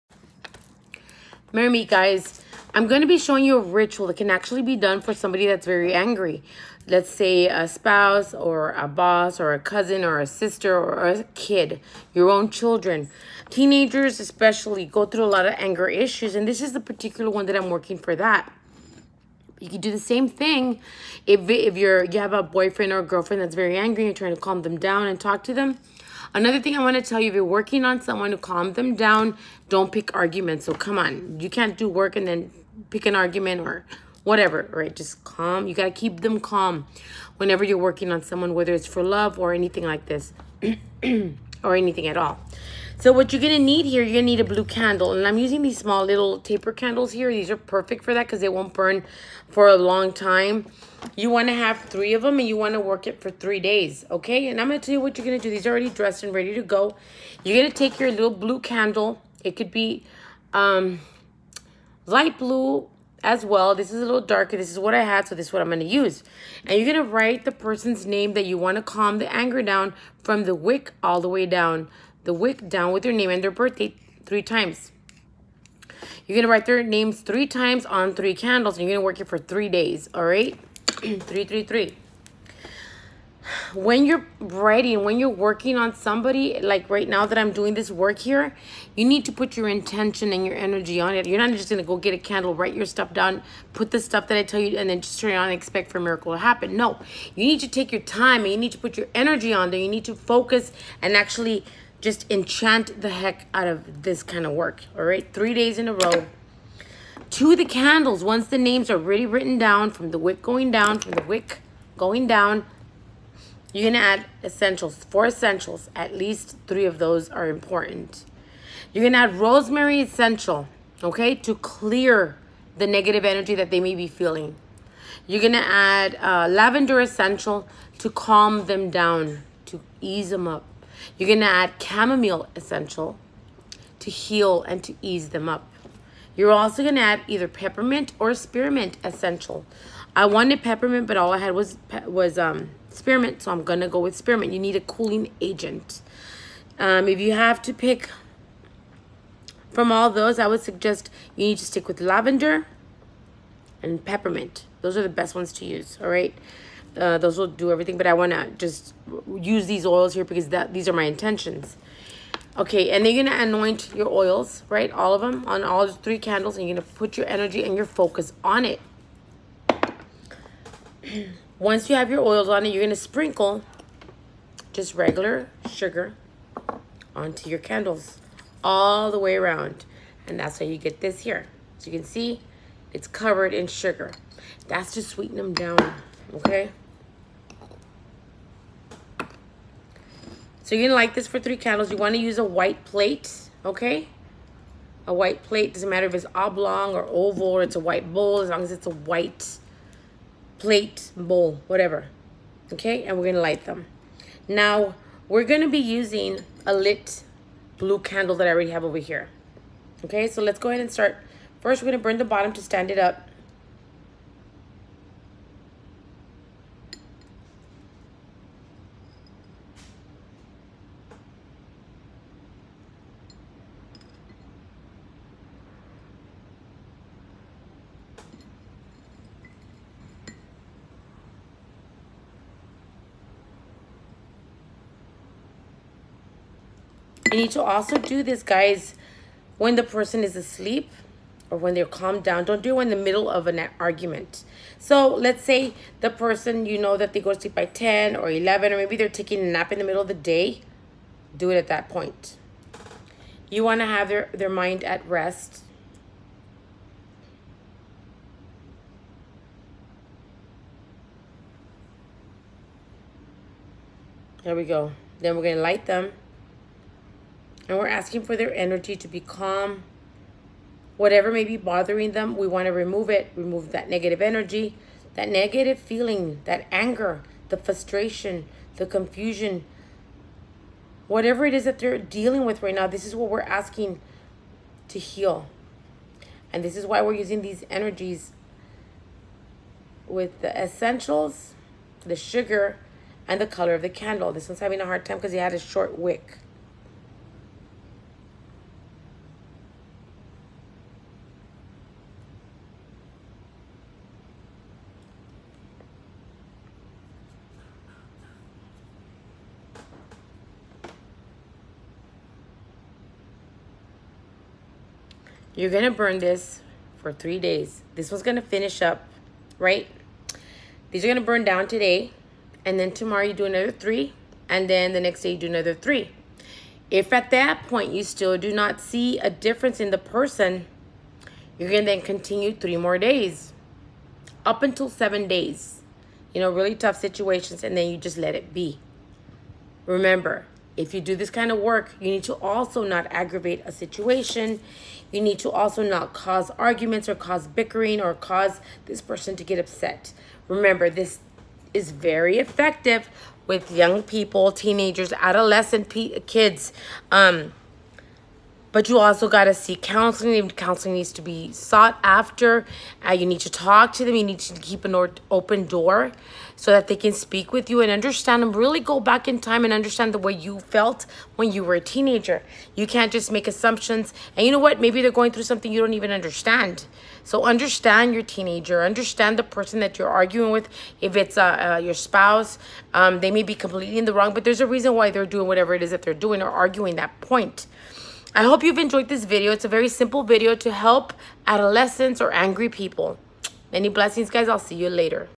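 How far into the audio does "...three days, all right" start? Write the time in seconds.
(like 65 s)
79 s.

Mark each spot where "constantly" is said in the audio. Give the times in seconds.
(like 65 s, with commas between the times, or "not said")
not said.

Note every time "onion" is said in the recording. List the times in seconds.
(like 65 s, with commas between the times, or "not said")
not said.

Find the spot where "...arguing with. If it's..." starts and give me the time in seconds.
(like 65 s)
380 s.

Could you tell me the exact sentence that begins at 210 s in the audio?
Okay, so let's go ahead and start.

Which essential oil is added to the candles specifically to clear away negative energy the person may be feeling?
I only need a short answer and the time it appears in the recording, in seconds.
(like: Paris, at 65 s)
Rosemary, at 119 s.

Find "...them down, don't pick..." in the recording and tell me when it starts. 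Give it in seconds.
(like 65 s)
28 s.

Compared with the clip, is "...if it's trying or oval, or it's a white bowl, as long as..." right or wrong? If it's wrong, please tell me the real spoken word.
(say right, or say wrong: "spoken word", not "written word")
wrong: "oblong", not "trying".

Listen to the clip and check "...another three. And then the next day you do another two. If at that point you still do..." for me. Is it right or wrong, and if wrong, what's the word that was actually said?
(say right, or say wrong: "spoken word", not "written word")
wrong: "three", not "two".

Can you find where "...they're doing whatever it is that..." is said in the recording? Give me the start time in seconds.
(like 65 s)
385 s.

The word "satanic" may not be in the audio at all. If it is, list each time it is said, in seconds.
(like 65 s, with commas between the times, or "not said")
not said.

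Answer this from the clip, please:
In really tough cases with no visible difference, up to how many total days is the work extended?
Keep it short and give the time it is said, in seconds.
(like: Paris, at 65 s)
7, at 334 s.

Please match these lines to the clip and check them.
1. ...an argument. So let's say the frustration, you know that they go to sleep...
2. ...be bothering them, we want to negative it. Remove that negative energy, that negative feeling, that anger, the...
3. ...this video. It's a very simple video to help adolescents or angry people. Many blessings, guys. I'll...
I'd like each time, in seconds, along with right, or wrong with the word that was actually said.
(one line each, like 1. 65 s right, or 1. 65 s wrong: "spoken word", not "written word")
1. 243 s wrong: "person", not "frustration"
2. 271 s wrong: "remove", not "negative"
3. 389 s right.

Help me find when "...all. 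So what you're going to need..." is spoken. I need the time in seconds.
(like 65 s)
42 s.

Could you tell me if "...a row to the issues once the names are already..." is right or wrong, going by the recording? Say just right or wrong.
wrong.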